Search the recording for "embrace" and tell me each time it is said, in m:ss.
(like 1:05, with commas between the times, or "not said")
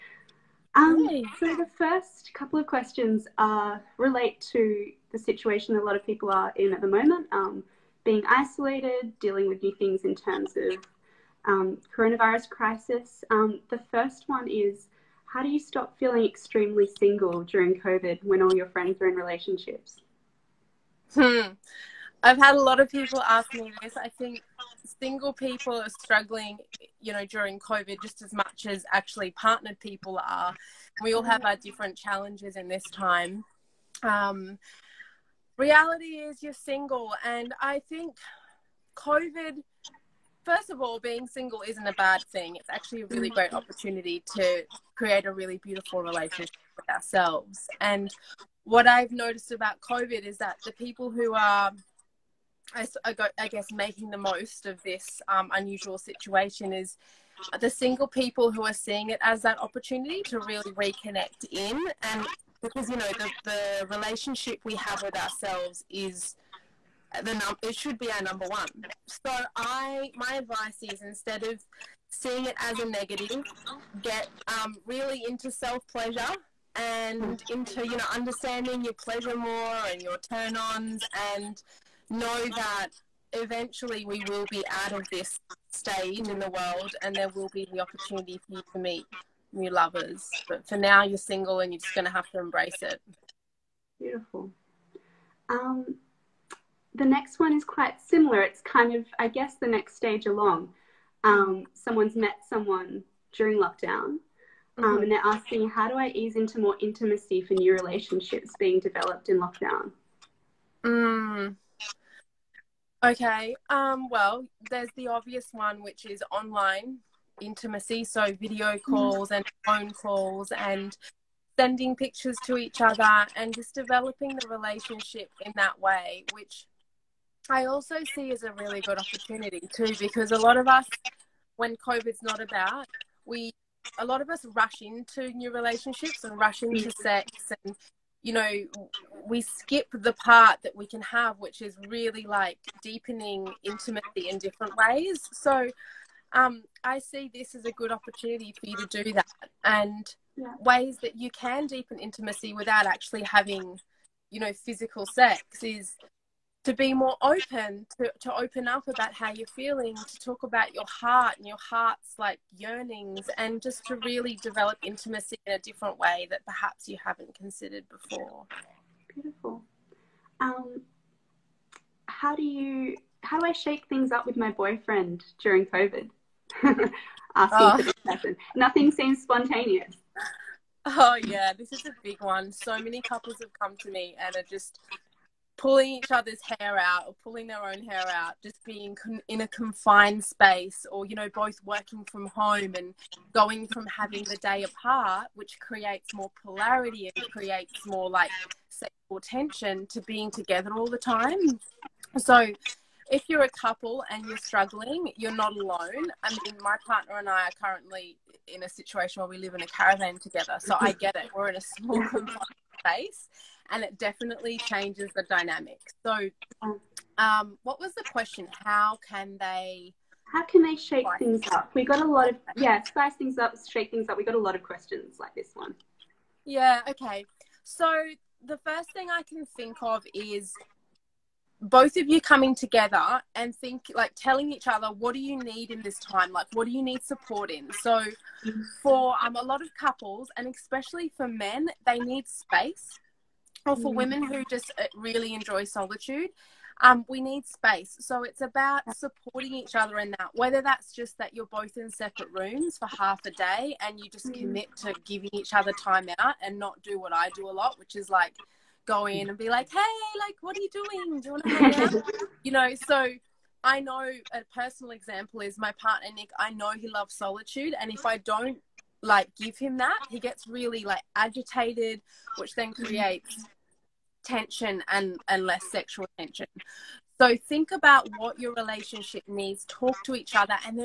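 1:32.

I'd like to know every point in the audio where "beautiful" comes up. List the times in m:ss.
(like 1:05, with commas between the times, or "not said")
0:45, 1:33, 2:49.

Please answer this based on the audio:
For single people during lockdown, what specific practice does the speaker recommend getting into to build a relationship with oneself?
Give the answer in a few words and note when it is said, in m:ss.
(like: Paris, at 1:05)
Self pleasure, at 1:15.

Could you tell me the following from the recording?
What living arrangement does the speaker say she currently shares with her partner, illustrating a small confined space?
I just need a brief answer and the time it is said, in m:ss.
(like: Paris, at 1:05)
A caravan, at 3:29.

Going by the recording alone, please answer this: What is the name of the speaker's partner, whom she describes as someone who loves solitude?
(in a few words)
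Nick.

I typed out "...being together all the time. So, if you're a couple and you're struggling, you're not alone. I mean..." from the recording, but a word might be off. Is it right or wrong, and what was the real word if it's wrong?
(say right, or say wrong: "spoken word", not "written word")
right.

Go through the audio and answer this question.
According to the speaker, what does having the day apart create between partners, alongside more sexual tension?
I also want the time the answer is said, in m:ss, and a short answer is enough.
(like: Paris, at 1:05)
Polarity, at 3:16.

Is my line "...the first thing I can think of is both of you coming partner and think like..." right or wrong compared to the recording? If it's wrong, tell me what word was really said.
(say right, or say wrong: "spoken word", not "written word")
wrong: "together", not "partner".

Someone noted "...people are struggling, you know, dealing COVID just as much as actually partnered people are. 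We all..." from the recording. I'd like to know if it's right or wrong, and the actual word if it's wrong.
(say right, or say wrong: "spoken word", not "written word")
wrong: "during", not "dealing".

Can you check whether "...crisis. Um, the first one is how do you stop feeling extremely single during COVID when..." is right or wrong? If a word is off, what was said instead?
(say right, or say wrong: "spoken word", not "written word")
right.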